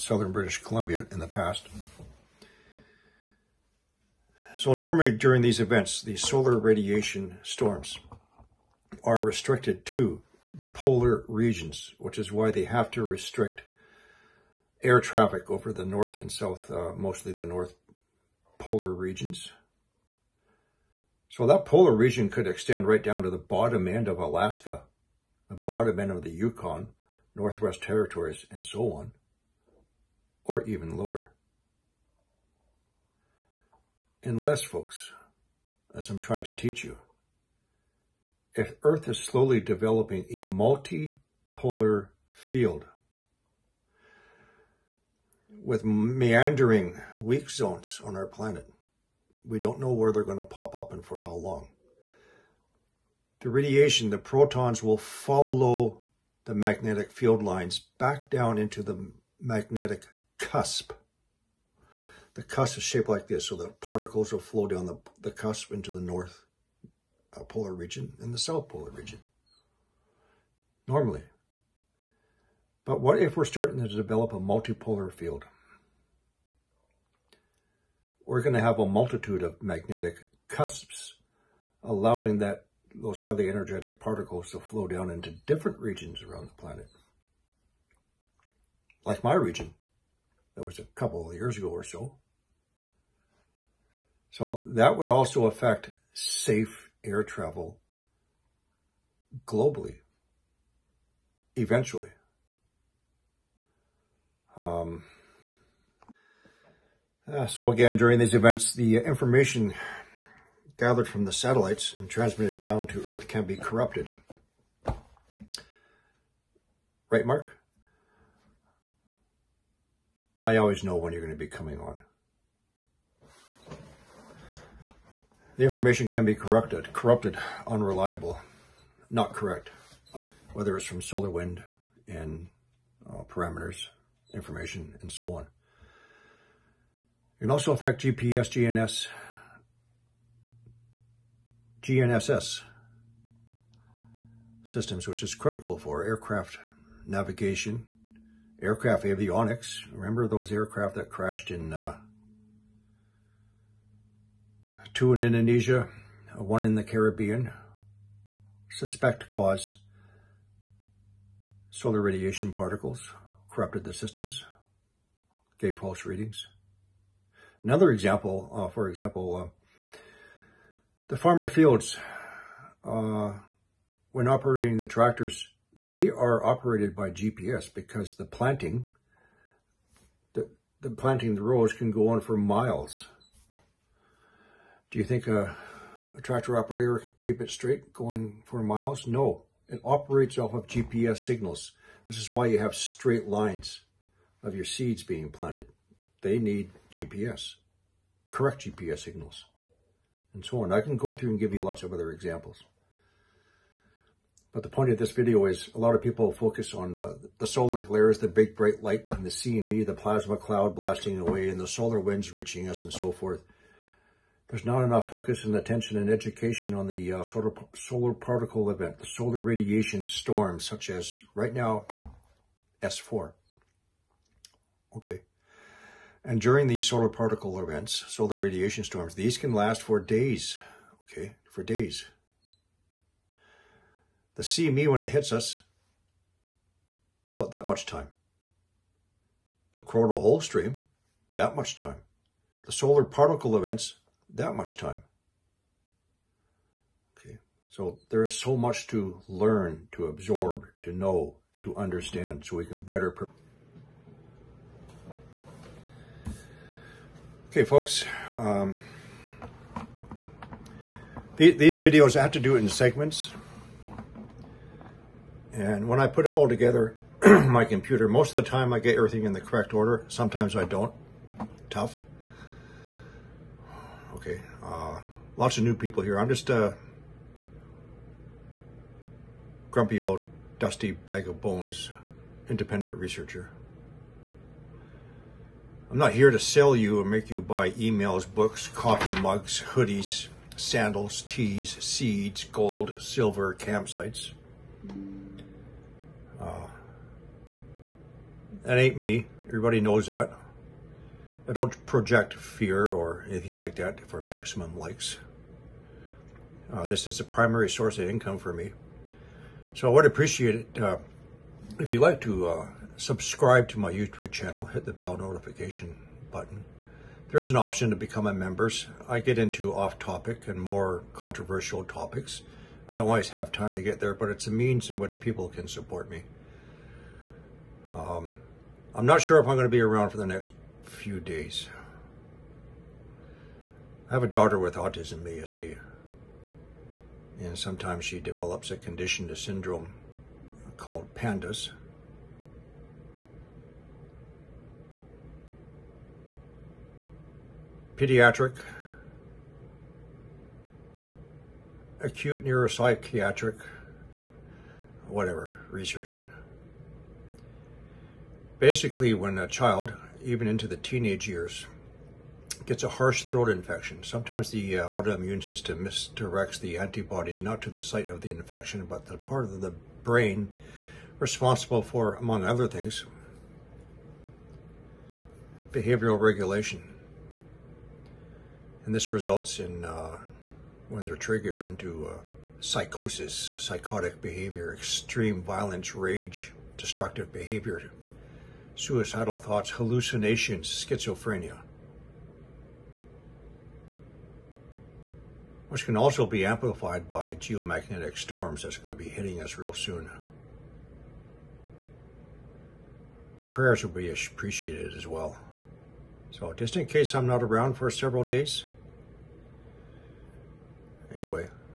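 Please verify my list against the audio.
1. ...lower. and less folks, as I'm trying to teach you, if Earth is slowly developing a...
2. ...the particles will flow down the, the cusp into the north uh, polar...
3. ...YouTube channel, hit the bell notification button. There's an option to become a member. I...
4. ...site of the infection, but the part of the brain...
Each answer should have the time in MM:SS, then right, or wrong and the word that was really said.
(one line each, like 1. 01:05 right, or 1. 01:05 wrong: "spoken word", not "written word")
1. 00:30 right
2. 01:03 right
3. 05:13 right
4. 06:07 right.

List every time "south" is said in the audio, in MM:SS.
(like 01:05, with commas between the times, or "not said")
00:16, 01:08.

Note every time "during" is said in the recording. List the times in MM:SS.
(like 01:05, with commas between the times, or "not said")
00:05, 01:47, 03:46.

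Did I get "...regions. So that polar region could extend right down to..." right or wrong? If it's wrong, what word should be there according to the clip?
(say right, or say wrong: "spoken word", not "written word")
right.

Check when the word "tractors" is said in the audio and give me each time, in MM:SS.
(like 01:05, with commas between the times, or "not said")
02:54, 03:06.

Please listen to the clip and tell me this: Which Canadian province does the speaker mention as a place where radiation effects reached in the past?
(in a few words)
British Columbia.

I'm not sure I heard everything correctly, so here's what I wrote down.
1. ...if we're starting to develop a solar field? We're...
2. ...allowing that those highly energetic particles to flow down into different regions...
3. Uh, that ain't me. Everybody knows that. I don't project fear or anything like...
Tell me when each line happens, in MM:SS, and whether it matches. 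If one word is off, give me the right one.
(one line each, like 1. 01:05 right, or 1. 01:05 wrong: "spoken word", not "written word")
1. 01:13 wrong: "multipolar", not "solar"
2. 01:21 right
3. 04:56 right.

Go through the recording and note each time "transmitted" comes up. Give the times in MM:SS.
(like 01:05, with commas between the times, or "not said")
01:52.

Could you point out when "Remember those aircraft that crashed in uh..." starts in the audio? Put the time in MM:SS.
02:29.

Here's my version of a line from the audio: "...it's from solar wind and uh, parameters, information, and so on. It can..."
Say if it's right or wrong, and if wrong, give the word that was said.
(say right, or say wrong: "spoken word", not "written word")
right.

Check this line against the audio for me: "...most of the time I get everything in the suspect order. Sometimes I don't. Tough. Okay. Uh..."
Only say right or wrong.
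wrong.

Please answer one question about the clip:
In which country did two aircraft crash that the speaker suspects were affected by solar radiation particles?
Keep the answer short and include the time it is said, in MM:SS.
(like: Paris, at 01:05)
Indonesia, at 02:35.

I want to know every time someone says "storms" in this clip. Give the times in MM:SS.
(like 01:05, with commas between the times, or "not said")
00:07, 03:40, 03:48, 06:38.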